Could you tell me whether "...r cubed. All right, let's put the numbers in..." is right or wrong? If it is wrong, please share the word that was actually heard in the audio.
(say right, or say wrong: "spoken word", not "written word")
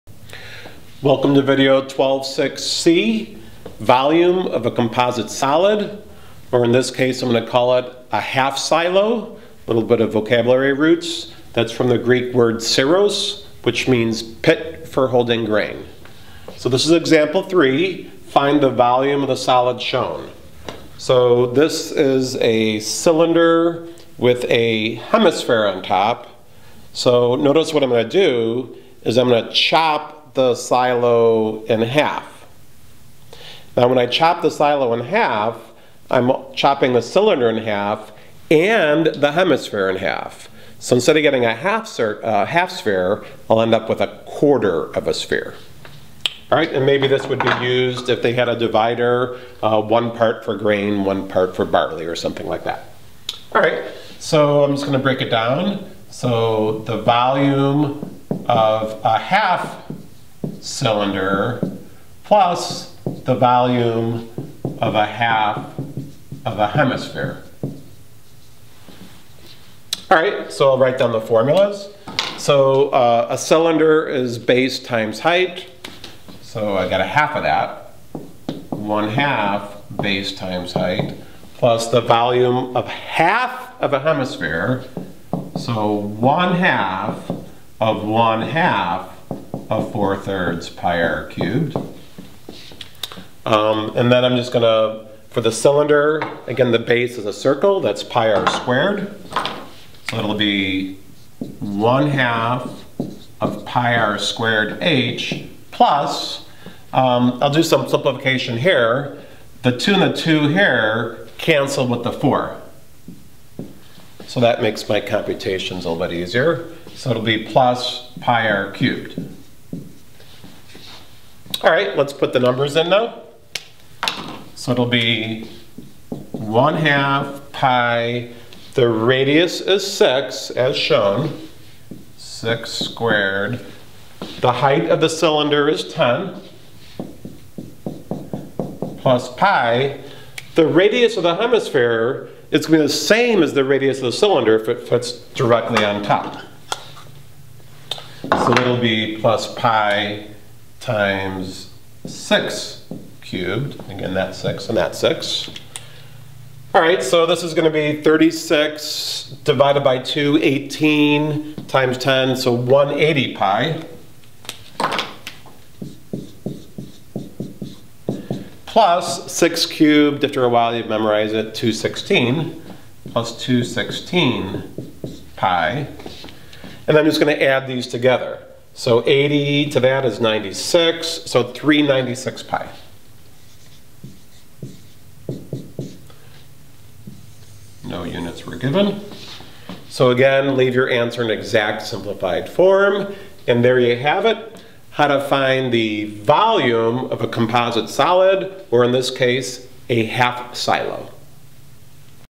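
right.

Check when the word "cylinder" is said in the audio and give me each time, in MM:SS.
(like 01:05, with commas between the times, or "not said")
00:22, 00:37, 01:00, 01:13, 01:35, 02:15, 02:24.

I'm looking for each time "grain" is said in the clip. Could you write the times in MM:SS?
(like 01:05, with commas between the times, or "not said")
00:15, 00:50.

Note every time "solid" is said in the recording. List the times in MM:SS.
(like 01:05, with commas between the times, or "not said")
00:05, 00:19, 03:17.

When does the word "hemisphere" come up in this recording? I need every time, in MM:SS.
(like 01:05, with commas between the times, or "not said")
00:24, 00:39, 01:06, 01:23, 02:21.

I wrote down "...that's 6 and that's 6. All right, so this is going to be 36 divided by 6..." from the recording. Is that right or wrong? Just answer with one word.
wrong.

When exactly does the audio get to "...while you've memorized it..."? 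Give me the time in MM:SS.
02:50.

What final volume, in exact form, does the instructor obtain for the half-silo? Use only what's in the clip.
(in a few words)
396 pi.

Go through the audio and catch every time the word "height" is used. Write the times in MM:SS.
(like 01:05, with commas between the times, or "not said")
01:15, 01:20, 02:14.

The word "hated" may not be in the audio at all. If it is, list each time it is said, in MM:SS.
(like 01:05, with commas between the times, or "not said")
not said.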